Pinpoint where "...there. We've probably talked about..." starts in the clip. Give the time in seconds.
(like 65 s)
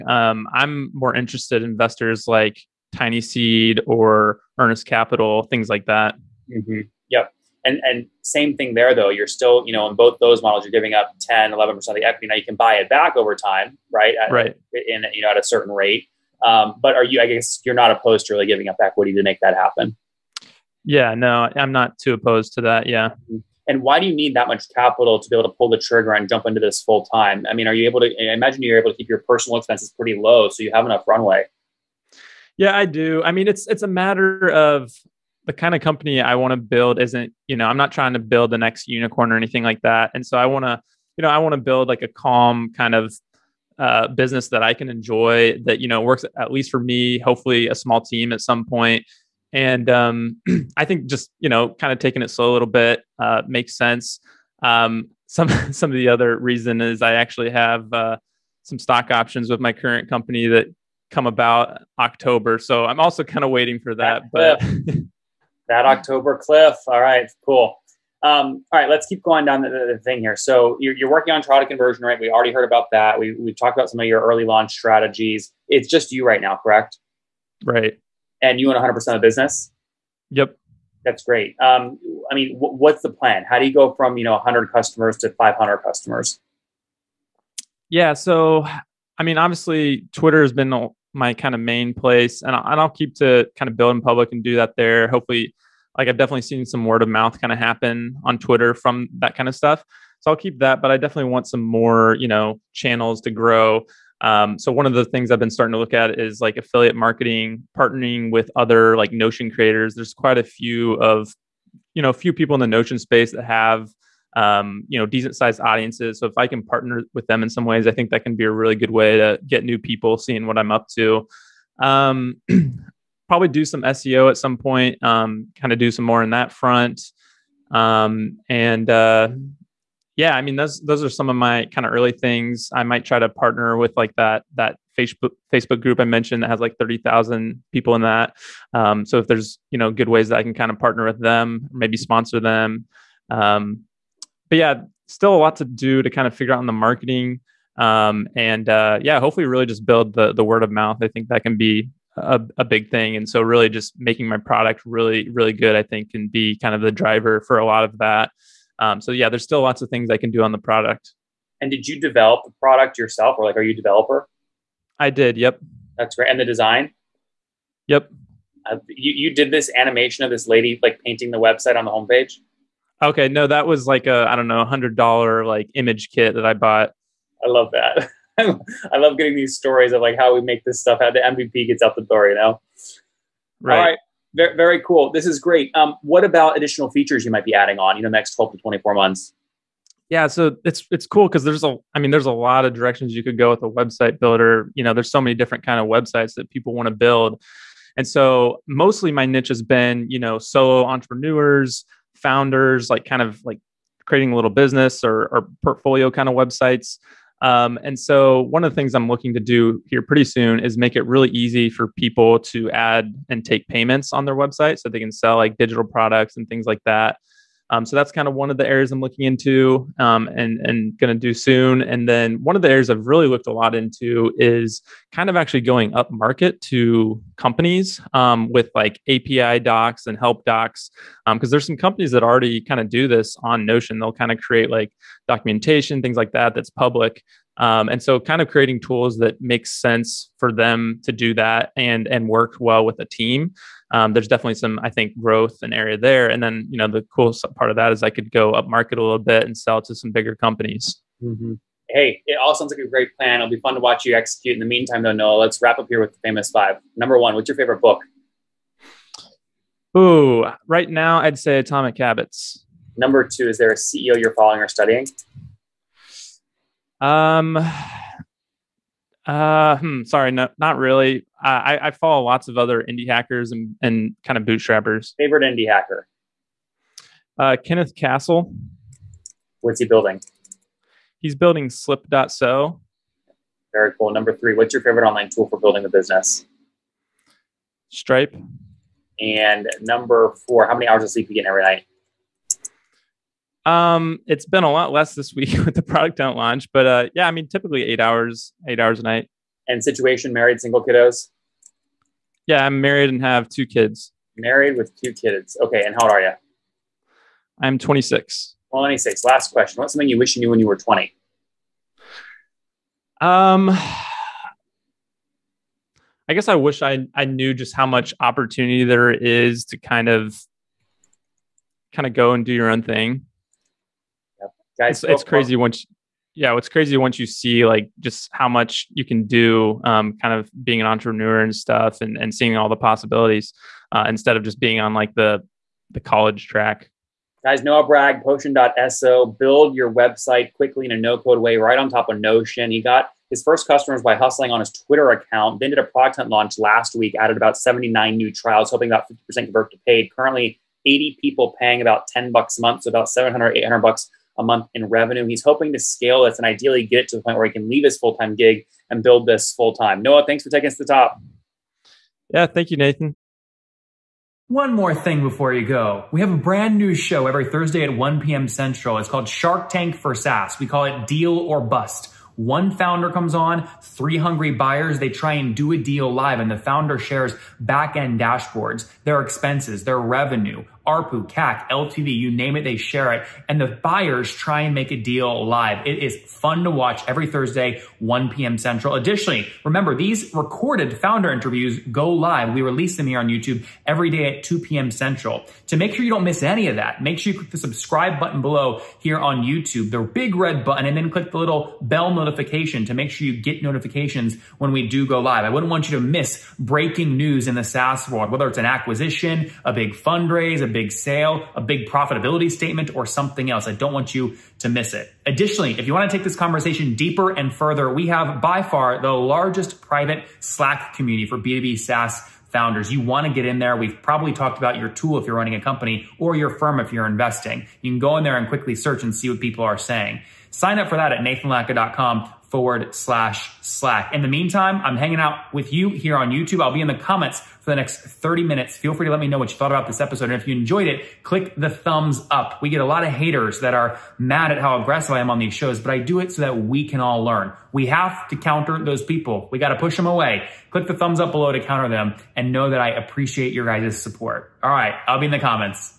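423 s.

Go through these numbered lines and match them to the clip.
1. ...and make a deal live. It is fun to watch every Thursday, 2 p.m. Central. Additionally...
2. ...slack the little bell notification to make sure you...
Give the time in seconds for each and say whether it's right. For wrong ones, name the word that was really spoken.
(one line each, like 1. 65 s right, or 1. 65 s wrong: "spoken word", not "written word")
1. 384 s wrong: "1", not "2"
2. 401 s wrong: "click", not "slack".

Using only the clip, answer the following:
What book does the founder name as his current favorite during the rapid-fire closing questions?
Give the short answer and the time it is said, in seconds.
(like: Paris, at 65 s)
Atomic Habits, at 261 s.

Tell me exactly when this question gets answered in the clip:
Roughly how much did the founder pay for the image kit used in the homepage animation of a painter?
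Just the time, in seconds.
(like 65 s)
174 s.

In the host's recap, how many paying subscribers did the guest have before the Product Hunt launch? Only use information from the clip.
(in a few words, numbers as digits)
79.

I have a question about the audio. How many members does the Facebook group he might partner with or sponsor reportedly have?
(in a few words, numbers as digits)
30,000.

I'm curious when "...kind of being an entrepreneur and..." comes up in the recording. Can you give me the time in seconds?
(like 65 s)
330 s.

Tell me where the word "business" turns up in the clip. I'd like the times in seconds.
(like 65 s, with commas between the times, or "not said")
44 s, 79 s, 204 s, 285 s.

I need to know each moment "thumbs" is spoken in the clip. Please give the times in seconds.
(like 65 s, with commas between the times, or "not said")
441 s, 450 s.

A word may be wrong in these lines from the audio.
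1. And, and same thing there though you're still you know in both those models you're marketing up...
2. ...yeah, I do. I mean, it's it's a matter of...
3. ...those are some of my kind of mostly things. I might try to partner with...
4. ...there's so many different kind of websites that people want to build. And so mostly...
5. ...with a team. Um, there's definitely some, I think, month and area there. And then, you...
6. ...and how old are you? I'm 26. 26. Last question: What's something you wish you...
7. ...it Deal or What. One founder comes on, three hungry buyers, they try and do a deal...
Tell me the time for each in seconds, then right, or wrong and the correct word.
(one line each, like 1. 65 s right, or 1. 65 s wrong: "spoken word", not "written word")
1. 7 s wrong: "giving", not "marketing"
2. 32 s right
3. 130 s wrong: "early", not "mostly"
4. 194 s right
5. 242 s wrong: "growth", not "month"
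6. 305 s right
7. 370 s wrong: "Bust", not "What".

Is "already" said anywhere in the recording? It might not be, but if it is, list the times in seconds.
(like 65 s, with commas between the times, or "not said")
72 s, 232 s.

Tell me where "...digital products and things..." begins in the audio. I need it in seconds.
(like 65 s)
215 s.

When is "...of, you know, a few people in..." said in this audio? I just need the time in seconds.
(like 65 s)
110 s.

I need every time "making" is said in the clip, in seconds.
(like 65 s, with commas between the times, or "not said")
153 s.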